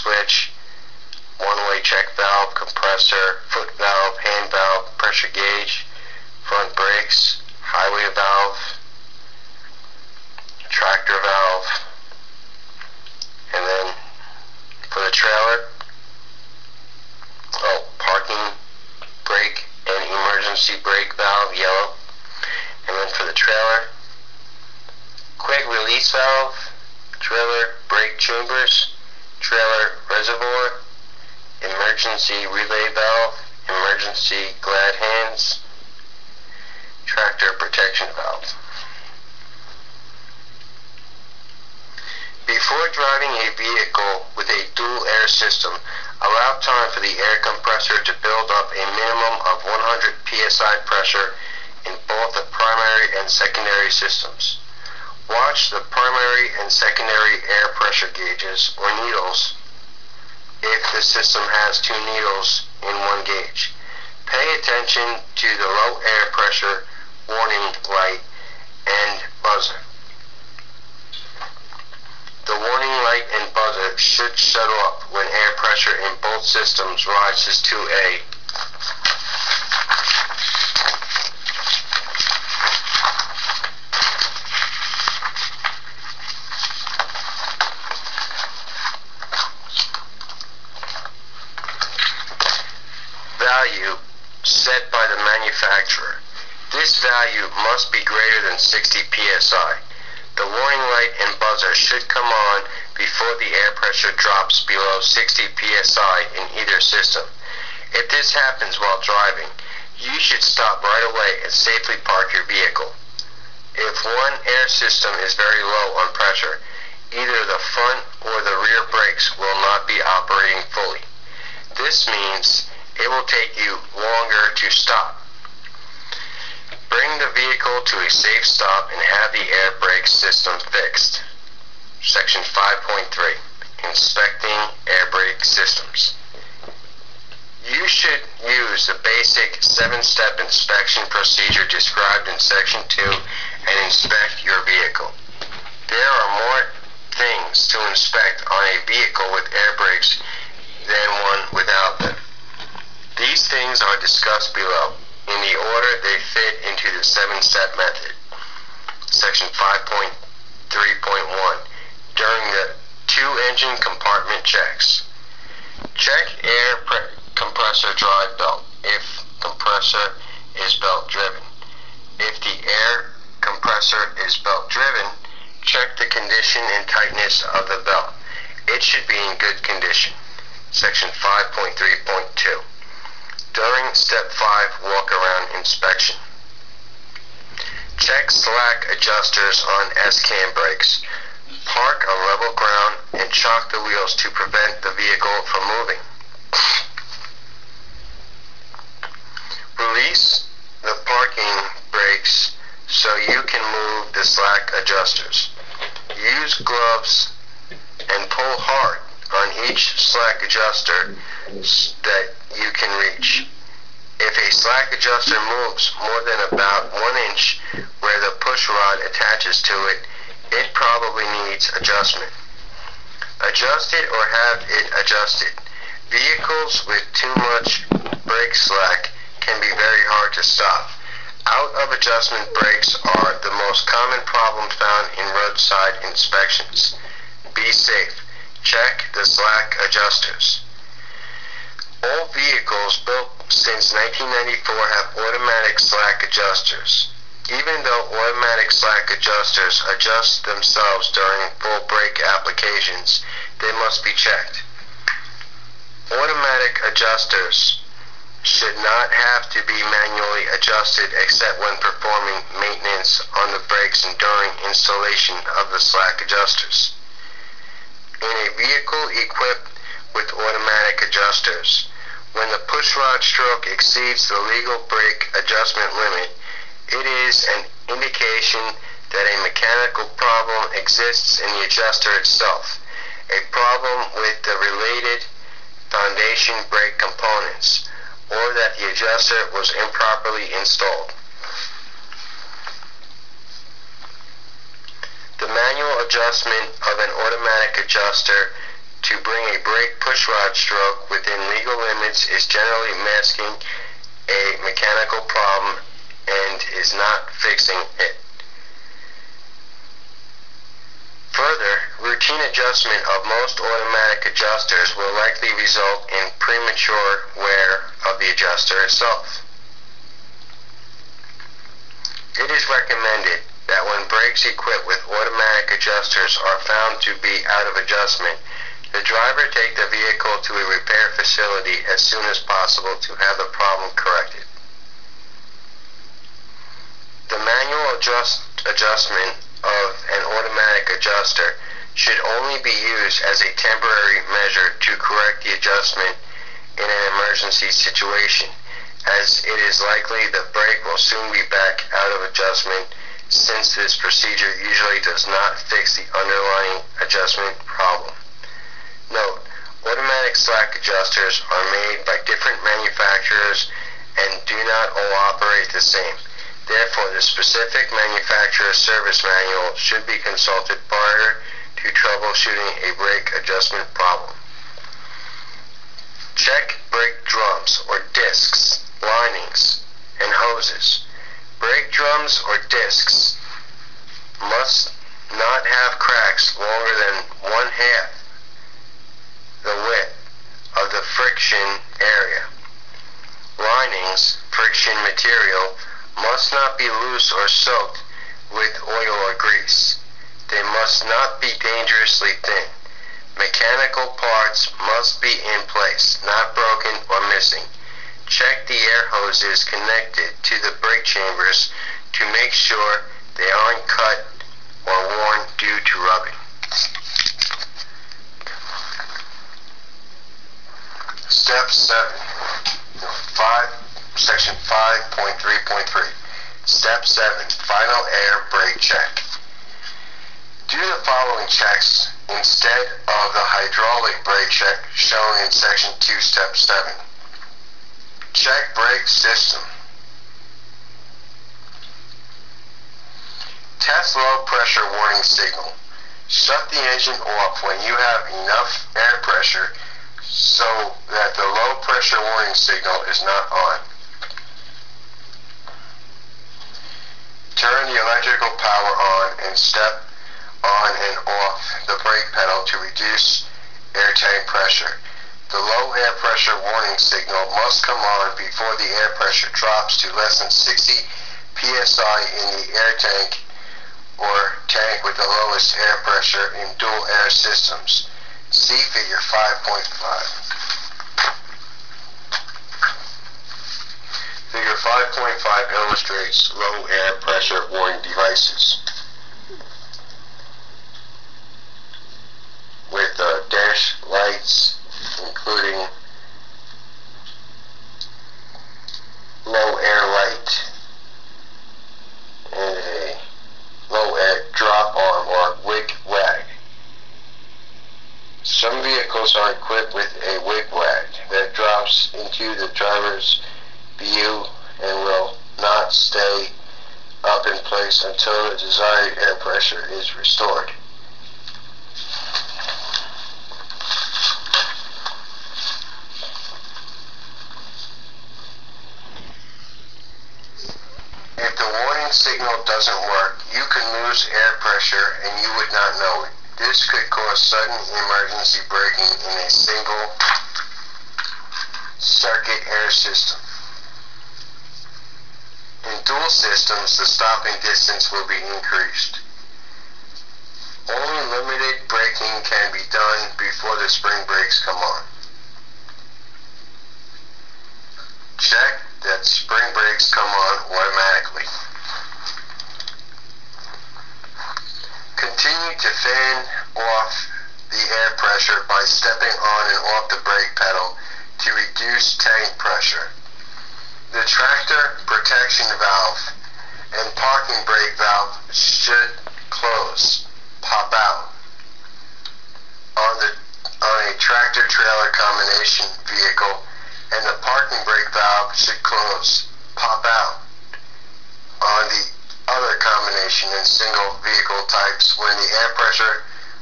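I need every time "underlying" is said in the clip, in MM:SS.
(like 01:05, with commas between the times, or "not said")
05:56.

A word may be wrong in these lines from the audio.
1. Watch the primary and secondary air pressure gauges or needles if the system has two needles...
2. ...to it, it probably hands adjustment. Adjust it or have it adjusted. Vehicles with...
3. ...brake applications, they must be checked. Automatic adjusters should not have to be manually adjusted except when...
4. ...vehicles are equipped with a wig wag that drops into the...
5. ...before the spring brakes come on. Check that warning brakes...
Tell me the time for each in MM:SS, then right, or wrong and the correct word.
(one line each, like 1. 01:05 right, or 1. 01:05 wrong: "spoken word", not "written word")
1. 00:55 right
2. 03:39 wrong: "needs", not "hands"
3. 04:11 right
4. 08:28 right
5. 09:13 wrong: "spring", not "warning".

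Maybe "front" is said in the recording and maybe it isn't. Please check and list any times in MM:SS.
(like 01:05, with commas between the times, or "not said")
00:06, 01:57.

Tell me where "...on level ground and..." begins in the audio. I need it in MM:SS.
03:12.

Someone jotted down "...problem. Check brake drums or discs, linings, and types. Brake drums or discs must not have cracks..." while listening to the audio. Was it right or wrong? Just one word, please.
wrong.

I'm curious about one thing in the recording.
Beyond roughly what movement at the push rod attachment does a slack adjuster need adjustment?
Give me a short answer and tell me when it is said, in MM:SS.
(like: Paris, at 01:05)
about one inch, at 03:36.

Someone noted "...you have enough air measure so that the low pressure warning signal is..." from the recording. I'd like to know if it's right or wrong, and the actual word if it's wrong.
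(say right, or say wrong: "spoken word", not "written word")
wrong: "pressure", not "measure".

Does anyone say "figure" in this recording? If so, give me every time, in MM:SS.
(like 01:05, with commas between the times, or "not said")
07:58, 08:04.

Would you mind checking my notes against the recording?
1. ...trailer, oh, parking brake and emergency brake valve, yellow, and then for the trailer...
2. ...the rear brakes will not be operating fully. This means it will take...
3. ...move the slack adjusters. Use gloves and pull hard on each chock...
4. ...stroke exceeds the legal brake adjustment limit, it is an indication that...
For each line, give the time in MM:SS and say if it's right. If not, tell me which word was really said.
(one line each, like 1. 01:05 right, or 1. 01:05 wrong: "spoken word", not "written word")
1. 00:15 right
2. 01:58 right
3. 03:23 wrong: "slack", not "chock"
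4. 04:33 right.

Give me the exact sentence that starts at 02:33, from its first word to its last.
These things are discussed below in the order they fit into the seven-step method.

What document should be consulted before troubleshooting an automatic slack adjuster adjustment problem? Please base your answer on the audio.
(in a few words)
manufacturer's service manual.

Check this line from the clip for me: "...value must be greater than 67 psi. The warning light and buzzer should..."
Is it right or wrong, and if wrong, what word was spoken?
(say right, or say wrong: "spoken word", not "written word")
wrong: "60", not "67".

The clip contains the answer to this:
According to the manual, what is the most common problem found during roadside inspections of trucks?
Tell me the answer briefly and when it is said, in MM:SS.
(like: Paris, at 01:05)
Out of adjustment brakes, at 03:51.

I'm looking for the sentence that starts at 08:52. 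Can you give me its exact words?
doesn't work, you can lose air pressure and you would not know it.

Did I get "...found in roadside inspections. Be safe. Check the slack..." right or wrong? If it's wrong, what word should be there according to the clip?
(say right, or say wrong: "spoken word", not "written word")
right.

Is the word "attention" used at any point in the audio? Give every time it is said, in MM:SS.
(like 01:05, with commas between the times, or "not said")
01:04.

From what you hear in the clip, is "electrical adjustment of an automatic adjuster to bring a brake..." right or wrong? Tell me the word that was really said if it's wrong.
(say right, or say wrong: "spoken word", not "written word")
wrong: "manual", not "electrical".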